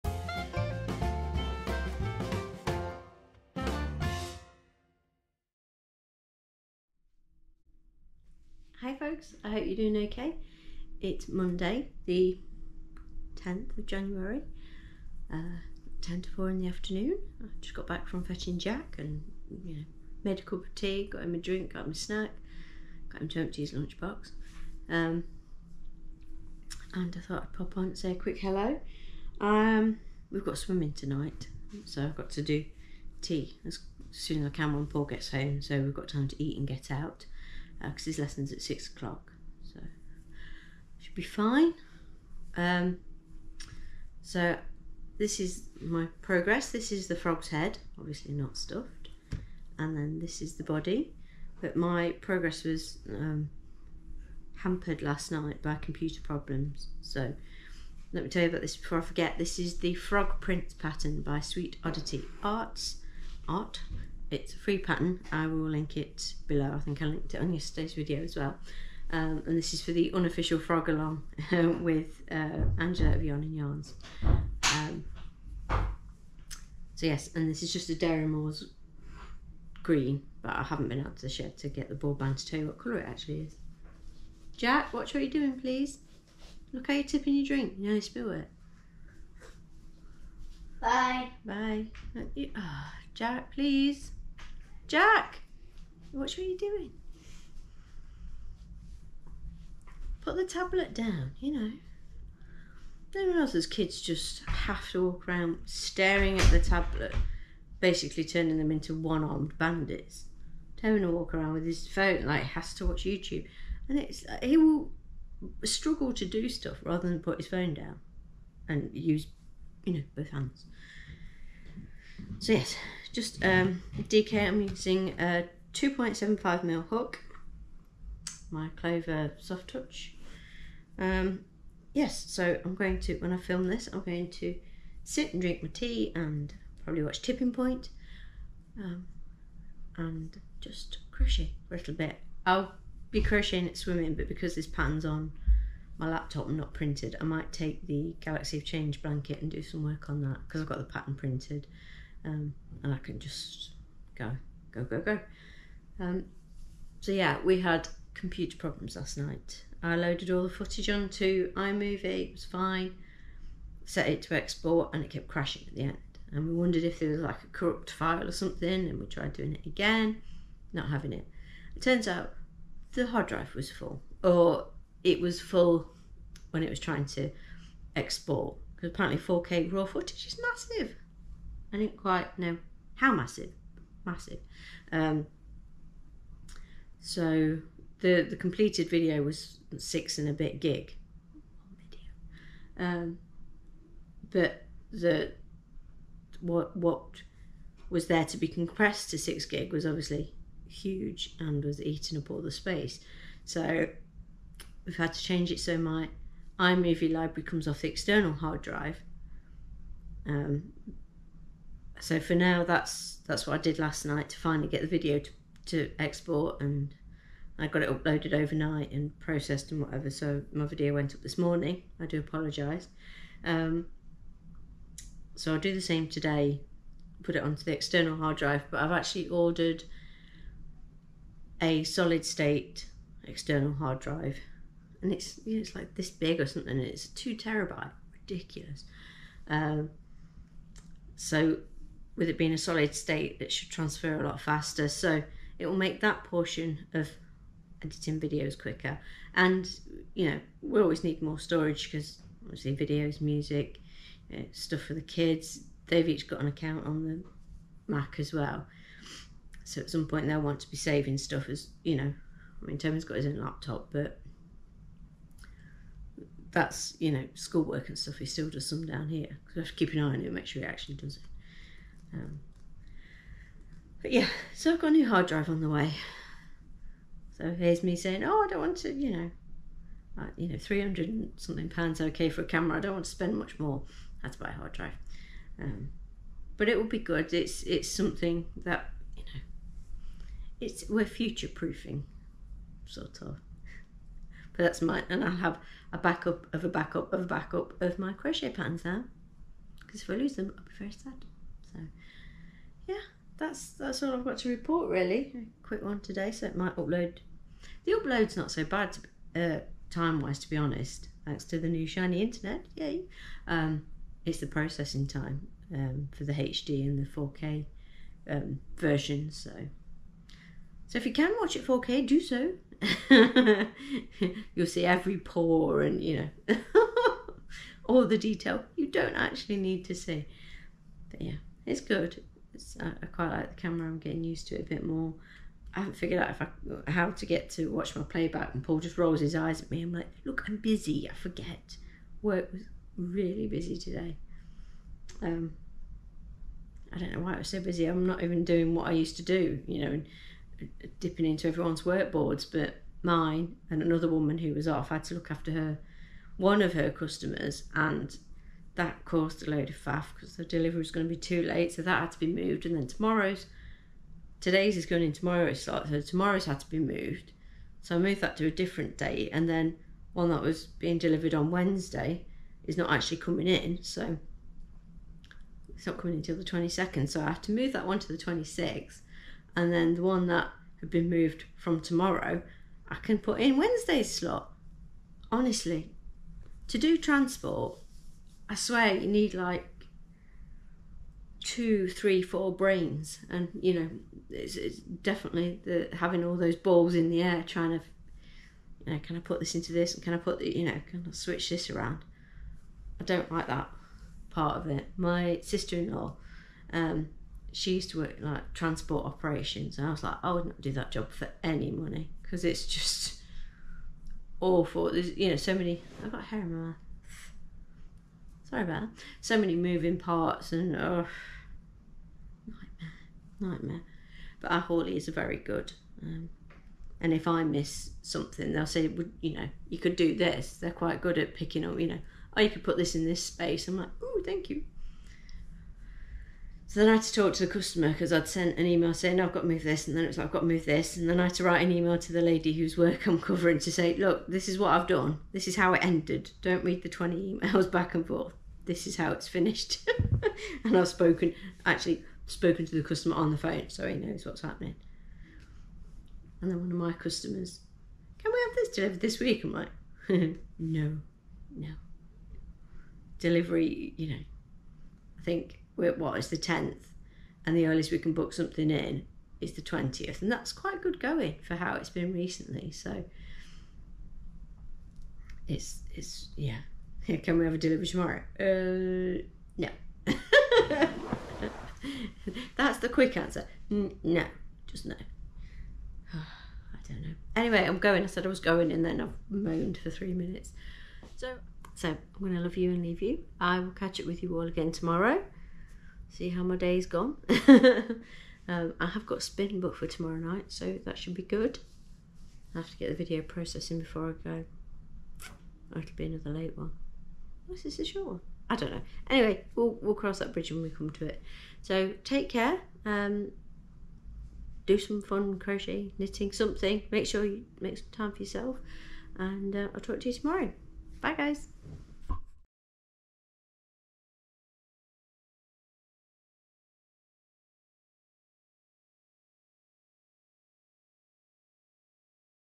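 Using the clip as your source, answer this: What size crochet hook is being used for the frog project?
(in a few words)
2.75mm.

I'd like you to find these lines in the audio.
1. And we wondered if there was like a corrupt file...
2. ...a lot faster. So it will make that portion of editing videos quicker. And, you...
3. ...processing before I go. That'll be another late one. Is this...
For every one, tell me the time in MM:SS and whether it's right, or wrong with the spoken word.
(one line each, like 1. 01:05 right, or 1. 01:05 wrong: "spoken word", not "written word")
1. 02:46 right
2. 04:04 right
3. 08:23 right.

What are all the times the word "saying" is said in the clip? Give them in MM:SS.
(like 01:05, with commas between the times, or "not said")
04:37, 07:18.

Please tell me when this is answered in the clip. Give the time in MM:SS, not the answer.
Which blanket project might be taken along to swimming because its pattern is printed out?
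02:28.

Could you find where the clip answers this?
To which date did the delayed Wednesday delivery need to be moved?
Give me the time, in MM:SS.
06:18.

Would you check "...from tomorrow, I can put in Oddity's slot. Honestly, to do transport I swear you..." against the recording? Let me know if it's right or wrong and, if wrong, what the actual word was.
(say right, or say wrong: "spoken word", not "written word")
wrong: "Wednesday", not "Oddity".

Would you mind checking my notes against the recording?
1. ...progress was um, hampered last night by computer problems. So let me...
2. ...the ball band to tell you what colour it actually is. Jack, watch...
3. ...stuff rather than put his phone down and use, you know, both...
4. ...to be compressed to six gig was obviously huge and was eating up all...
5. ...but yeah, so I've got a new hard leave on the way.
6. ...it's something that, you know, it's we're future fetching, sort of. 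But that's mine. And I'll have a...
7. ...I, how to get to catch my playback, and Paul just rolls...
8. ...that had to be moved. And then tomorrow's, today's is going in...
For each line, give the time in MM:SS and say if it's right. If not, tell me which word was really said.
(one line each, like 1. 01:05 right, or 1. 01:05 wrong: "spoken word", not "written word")
1. 00:52 right
2. 01:21 right
3. 01:56 right
4. 03:18 right
5. 04:34 wrong: "drive", not "leave"
6. 04:47 wrong: "proofing", not "fetching"
7. 05:36 wrong: "watch", not "catch"
8. 06:01 right.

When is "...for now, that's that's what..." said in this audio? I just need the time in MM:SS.
03:32.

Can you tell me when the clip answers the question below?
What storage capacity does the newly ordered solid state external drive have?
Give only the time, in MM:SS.
03:57.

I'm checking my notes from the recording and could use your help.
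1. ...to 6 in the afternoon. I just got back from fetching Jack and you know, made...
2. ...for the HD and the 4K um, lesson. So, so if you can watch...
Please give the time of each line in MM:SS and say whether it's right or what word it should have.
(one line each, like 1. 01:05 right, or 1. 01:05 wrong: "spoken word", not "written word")
1. 00:16 wrong: "4", not "6"
2. 05:16 wrong: "version", not "lesson".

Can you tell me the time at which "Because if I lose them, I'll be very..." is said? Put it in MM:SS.
04:59.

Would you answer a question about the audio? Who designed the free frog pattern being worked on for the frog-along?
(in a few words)
Sweet Oddity Arts.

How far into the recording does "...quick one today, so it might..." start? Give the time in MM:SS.
05:05.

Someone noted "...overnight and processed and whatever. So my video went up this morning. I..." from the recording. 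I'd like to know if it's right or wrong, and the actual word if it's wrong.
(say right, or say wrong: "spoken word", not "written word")
right.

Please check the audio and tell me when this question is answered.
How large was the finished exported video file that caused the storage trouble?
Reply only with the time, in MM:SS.
03:09.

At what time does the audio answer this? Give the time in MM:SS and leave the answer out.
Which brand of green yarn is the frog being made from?
01:17.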